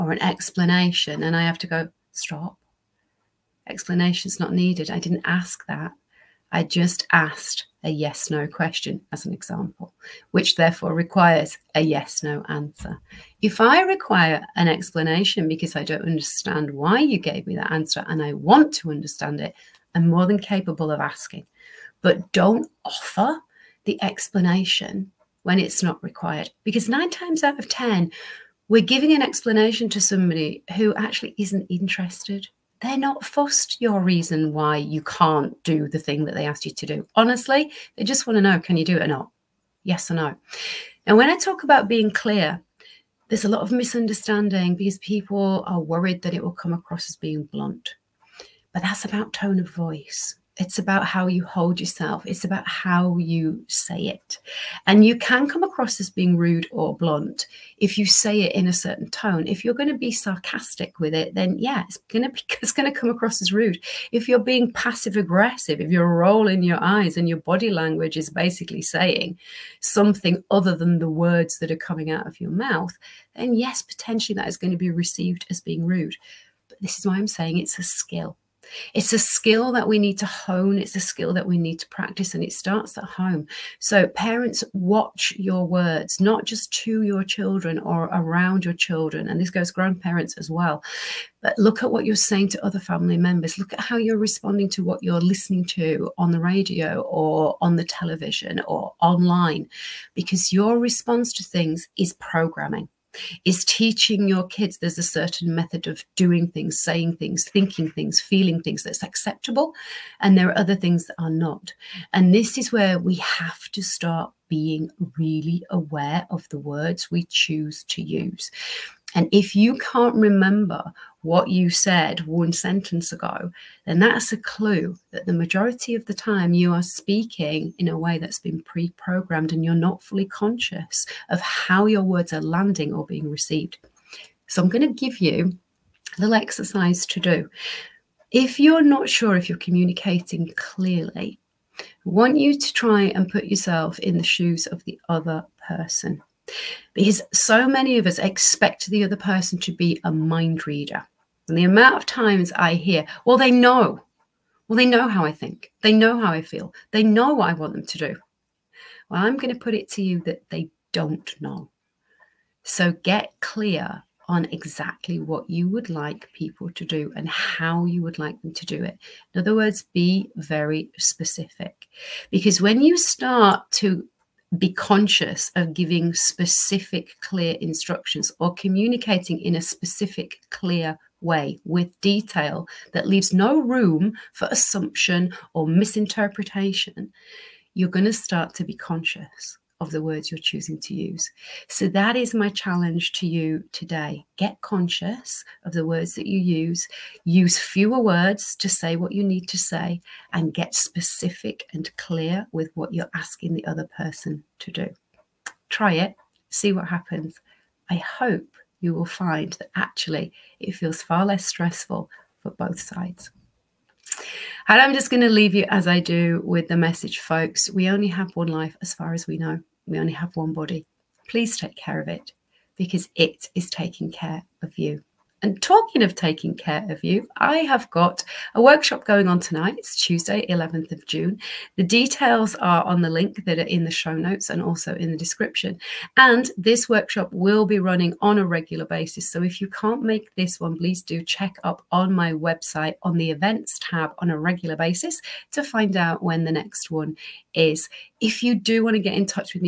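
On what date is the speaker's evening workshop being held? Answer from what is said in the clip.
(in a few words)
Tuesday, 11 June.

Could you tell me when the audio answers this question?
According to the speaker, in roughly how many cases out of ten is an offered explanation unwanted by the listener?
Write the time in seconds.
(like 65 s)
26 s.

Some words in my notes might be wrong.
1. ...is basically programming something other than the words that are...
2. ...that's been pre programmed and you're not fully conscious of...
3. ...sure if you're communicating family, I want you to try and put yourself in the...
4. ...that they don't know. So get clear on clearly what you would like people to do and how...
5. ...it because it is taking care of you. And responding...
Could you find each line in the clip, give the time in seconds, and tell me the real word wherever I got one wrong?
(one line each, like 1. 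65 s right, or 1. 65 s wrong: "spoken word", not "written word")
1. 68 s wrong: "saying", not "programming"
2. 128 s right
3. 139 s wrong: "clearly", not "family"
4. 160 s wrong: "exactly", not "clearly"
5. 222 s wrong: "talking", not "responding".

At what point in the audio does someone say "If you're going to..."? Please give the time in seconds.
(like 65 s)
59 s.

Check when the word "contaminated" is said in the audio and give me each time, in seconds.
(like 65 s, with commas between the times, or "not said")
not said.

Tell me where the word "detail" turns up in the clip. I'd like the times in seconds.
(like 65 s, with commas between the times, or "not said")
182 s, 231 s.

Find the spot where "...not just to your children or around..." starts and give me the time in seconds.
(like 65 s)
86 s.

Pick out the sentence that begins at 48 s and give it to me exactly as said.
But that's about tone of voice.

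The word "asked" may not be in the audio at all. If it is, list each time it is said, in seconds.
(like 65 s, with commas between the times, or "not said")
7 s, 36 s.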